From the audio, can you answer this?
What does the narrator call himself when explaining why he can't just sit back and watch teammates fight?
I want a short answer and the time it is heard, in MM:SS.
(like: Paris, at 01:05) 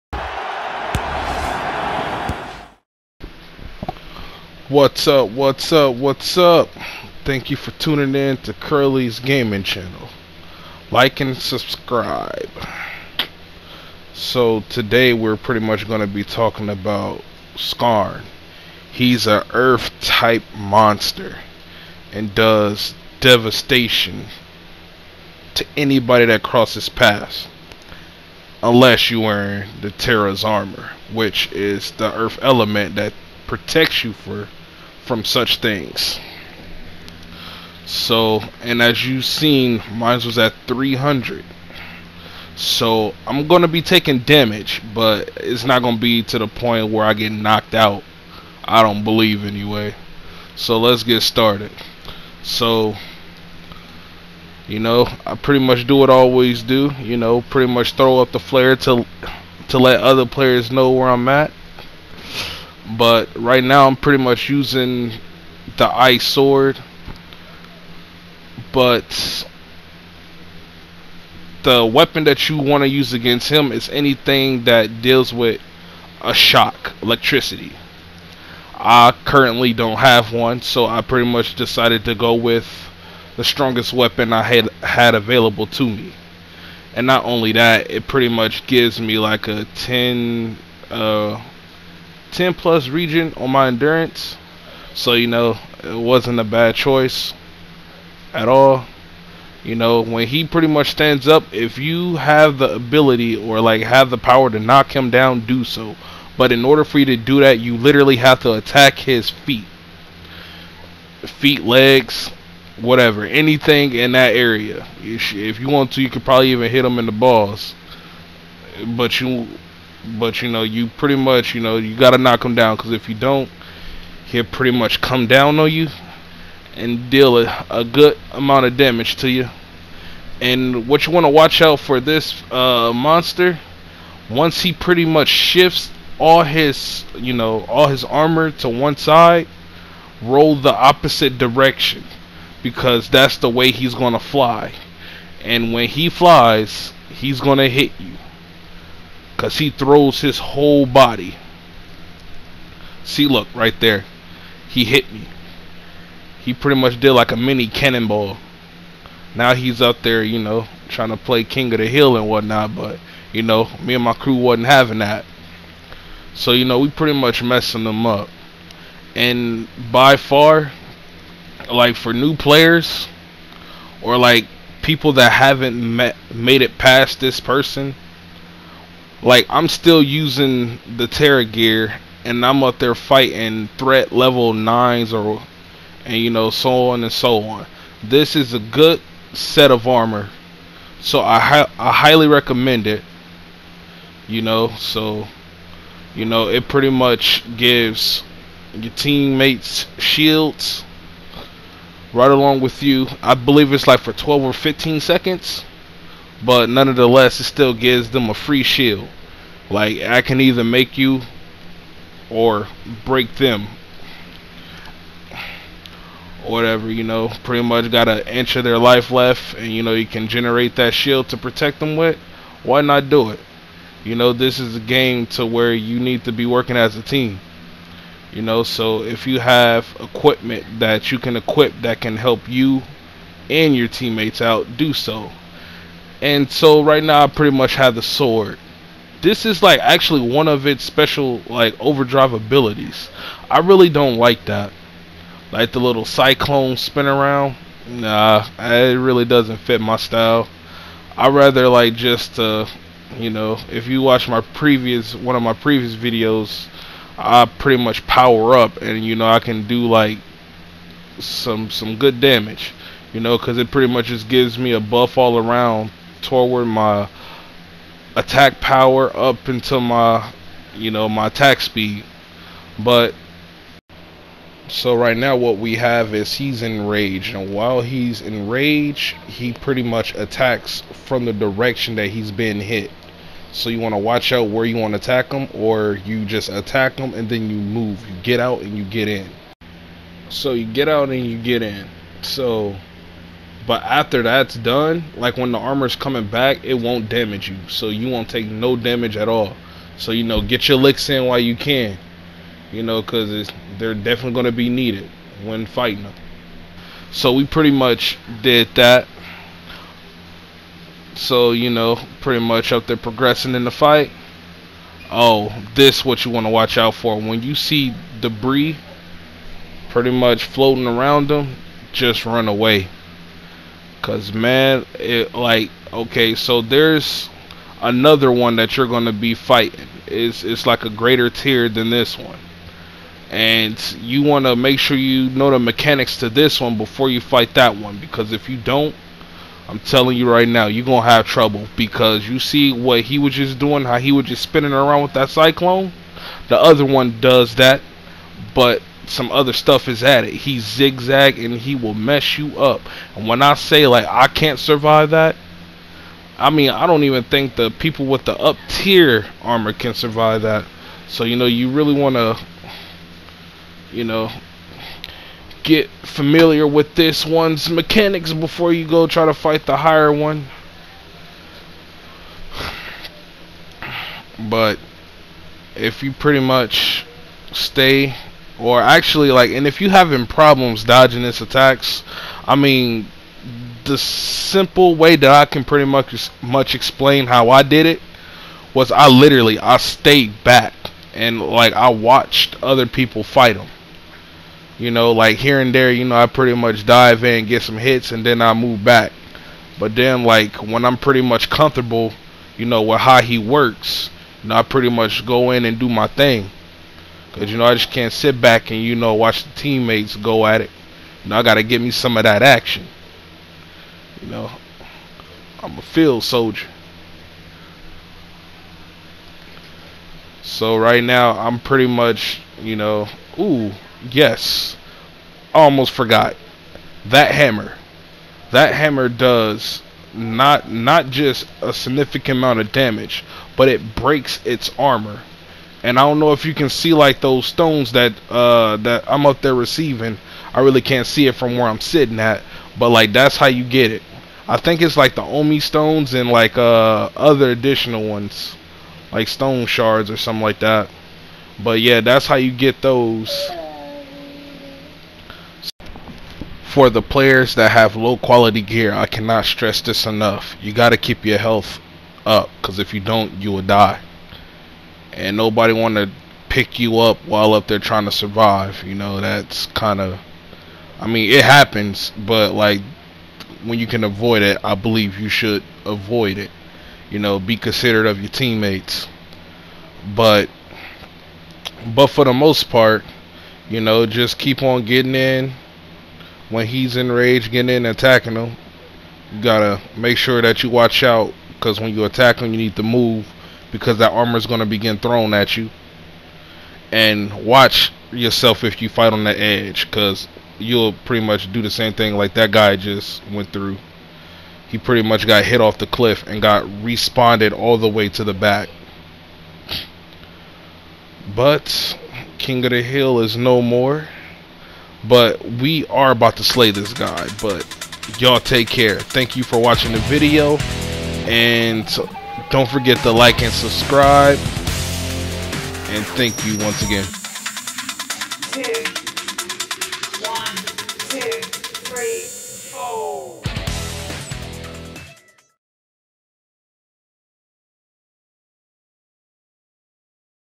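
a field soldier, at 06:55.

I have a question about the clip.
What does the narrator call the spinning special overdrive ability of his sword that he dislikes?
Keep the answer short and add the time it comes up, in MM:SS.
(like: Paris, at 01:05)
little cyclone spin, at 04:05.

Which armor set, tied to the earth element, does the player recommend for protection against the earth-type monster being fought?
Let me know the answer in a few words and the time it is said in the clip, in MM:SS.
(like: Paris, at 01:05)
Terra's armor, at 00:29.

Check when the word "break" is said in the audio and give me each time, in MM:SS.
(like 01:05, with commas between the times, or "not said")
03:33, 07:13.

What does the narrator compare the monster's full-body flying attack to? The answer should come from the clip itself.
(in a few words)
a mini cannonball.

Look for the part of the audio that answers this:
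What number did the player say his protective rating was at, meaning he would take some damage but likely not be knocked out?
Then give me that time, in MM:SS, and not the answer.
00:40.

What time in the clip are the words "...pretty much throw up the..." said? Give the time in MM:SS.
00:57.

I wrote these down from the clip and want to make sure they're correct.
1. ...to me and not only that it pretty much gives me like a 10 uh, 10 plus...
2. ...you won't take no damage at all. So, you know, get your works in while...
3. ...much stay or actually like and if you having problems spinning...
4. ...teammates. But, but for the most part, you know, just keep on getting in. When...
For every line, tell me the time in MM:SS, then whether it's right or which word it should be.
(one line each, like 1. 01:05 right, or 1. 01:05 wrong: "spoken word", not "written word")
1. 01:25 right
2. 04:57 wrong: "licks", not "works"
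3. 06:16 wrong: "dodging", not "spinning"
4. 07:58 right.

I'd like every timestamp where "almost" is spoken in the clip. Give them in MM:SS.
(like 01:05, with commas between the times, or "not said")
07:05.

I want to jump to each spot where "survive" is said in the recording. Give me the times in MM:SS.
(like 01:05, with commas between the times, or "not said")
05:54, 05:59, 07:48.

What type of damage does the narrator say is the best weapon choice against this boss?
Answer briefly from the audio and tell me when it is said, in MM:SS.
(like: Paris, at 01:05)
shock electricity, at 01:16.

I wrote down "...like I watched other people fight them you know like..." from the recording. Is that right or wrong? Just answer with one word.
right.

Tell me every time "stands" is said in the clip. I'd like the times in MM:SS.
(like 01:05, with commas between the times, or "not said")
01:40.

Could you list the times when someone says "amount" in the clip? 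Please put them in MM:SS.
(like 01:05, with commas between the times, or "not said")
02:08, 07:12.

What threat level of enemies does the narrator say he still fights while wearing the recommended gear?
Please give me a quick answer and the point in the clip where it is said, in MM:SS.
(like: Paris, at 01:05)
9, at 03:03.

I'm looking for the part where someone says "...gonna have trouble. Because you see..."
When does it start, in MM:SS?
05:40.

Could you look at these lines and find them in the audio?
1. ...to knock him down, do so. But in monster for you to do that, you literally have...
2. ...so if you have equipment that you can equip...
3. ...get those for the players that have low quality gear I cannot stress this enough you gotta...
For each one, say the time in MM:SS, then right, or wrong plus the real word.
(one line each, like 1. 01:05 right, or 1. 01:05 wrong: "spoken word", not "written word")
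1. 01:44 wrong: "order", not "monster"
2. 03:48 right
3. 07:32 right.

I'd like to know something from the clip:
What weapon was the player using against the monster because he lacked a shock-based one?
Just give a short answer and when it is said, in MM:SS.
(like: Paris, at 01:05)
ice sword, at 01:05.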